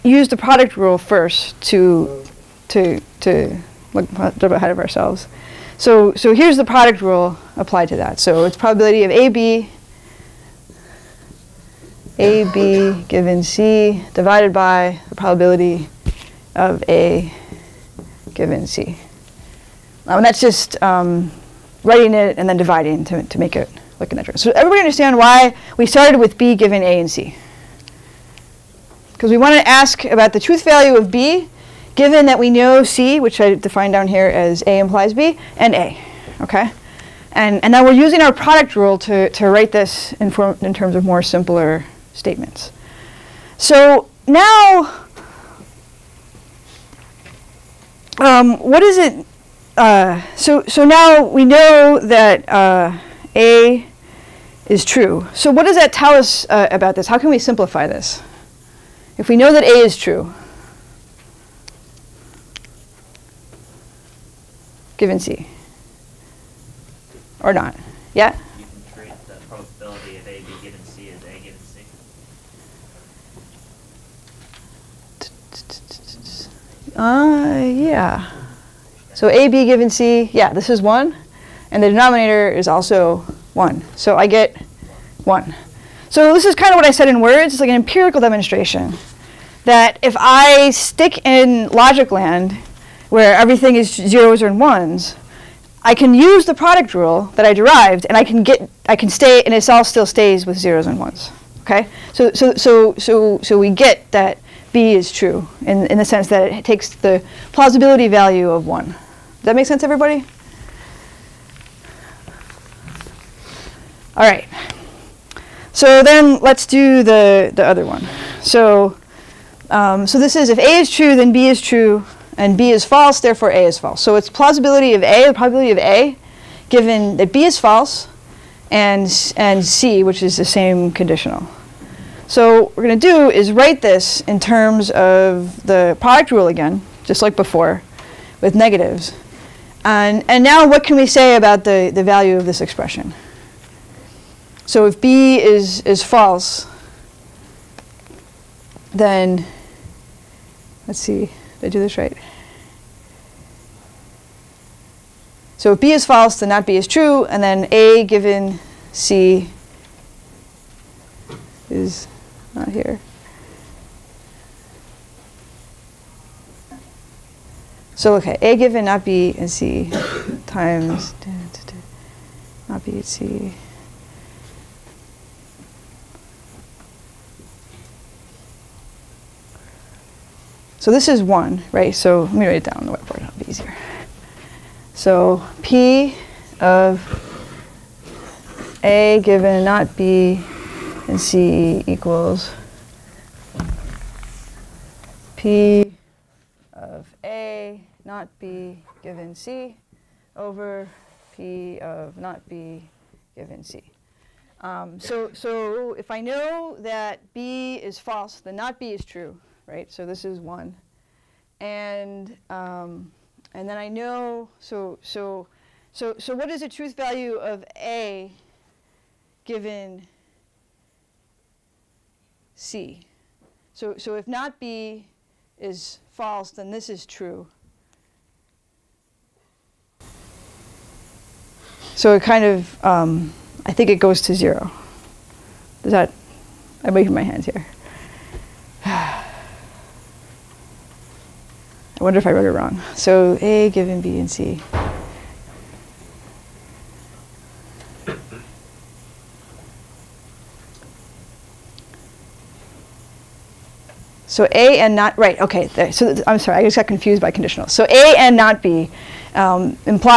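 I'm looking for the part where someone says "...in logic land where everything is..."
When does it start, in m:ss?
1:31.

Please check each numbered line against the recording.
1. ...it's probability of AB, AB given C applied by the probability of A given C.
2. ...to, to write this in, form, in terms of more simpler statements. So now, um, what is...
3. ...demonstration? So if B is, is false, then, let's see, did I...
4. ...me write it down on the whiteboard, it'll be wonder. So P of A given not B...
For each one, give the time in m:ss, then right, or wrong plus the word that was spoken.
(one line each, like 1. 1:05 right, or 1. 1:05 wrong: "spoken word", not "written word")
1. 0:08 wrong: "divided", not "applied"
2. 0:38 right
3. 2:22 wrong: "expression", not "demonstration"
4. 3:02 wrong: "easier", not "wonder".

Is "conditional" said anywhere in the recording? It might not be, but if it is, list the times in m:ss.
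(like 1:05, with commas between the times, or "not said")
2:10, 4:17.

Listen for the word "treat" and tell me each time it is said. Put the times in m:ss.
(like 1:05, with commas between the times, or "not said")
1:08.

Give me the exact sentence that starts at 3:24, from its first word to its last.
Um, so, so if I know that B is false, then not B is true, right?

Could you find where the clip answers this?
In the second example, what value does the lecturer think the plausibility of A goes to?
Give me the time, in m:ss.
3:53.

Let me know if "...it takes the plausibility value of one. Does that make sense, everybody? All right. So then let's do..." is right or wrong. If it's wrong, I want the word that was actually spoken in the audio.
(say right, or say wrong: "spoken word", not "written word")
right.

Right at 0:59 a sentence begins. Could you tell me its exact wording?
If we know that A is true, given C?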